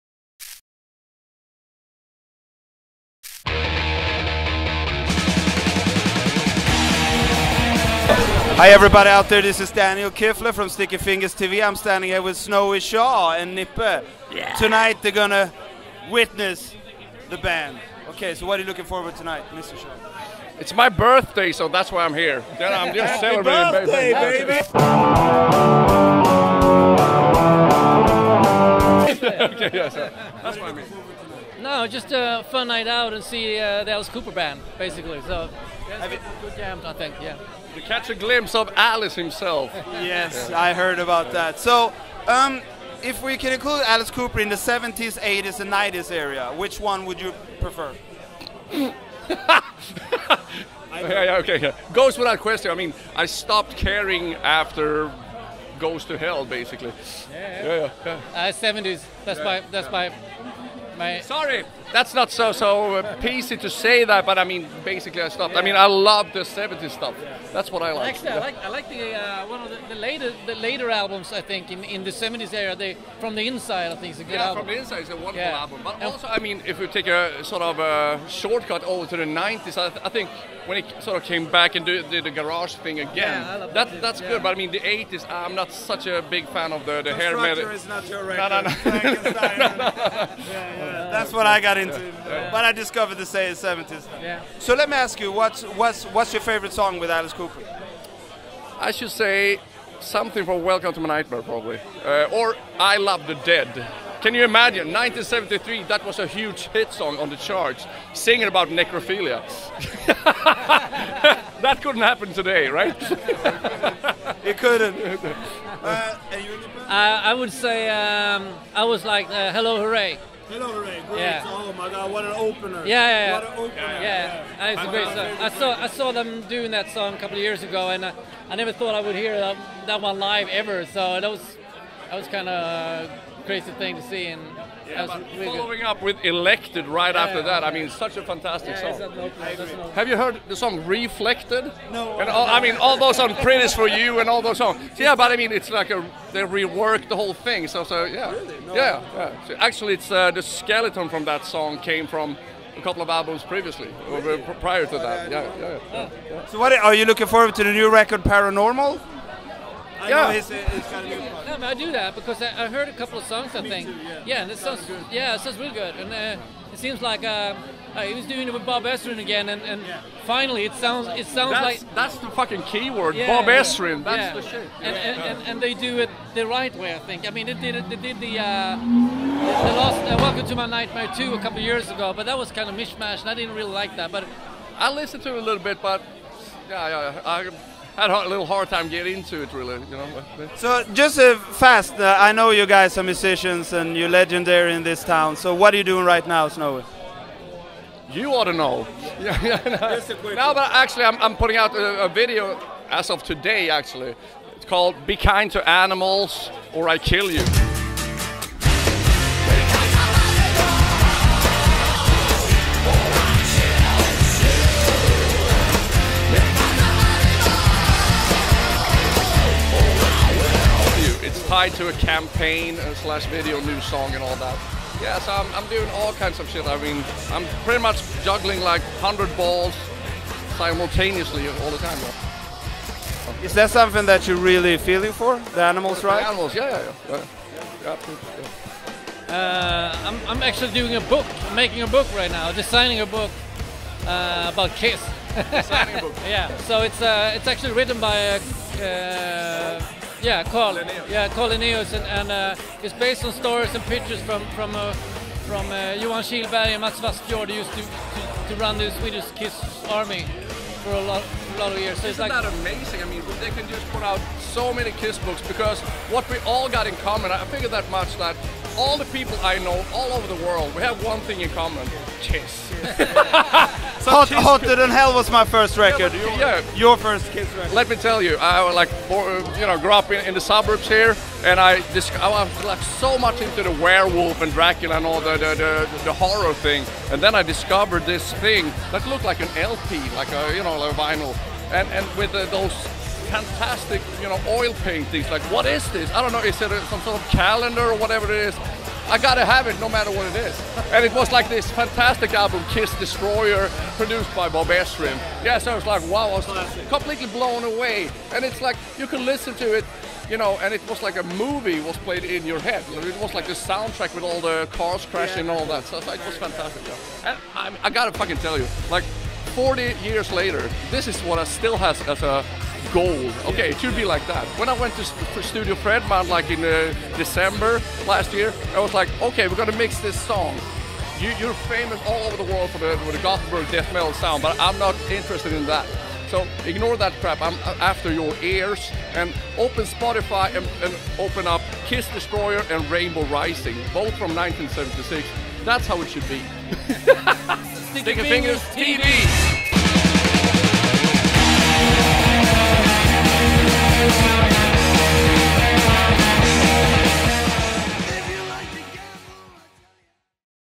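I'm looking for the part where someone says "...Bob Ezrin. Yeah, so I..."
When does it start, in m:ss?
5:04.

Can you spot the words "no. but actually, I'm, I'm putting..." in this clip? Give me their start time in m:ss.
3:20.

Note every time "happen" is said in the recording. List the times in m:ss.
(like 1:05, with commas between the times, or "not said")
1:52.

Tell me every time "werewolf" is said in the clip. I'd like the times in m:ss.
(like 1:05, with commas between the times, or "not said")
4:43.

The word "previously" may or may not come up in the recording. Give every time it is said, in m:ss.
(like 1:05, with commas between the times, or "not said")
2:33.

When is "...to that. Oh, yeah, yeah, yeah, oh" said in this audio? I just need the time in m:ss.
2:34.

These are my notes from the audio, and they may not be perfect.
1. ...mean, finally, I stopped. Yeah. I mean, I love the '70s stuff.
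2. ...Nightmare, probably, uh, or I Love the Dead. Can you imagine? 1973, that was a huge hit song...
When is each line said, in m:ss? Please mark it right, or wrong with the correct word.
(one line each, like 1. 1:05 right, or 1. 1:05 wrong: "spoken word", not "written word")
1. 1:04 wrong: "basically", not "finally"
2. 1:41 right.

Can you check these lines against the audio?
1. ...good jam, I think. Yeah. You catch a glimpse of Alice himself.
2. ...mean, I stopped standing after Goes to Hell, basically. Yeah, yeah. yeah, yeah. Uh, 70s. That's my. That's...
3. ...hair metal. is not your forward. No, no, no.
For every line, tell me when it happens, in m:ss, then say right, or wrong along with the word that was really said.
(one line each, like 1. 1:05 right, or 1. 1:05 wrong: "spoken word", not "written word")
1. 0:36 right
2. 0:52 wrong: "caring", not "standing"
3. 1:27 wrong: "record", not "forward".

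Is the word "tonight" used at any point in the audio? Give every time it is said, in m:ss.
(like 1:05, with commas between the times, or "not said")
0:14, 0:19.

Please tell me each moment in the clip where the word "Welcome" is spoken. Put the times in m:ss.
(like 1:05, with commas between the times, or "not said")
1:40, 3:00.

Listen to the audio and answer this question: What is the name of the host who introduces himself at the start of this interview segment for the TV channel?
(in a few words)
Daniel Kifler.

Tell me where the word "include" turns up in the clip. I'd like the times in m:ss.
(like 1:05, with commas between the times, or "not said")
0:43.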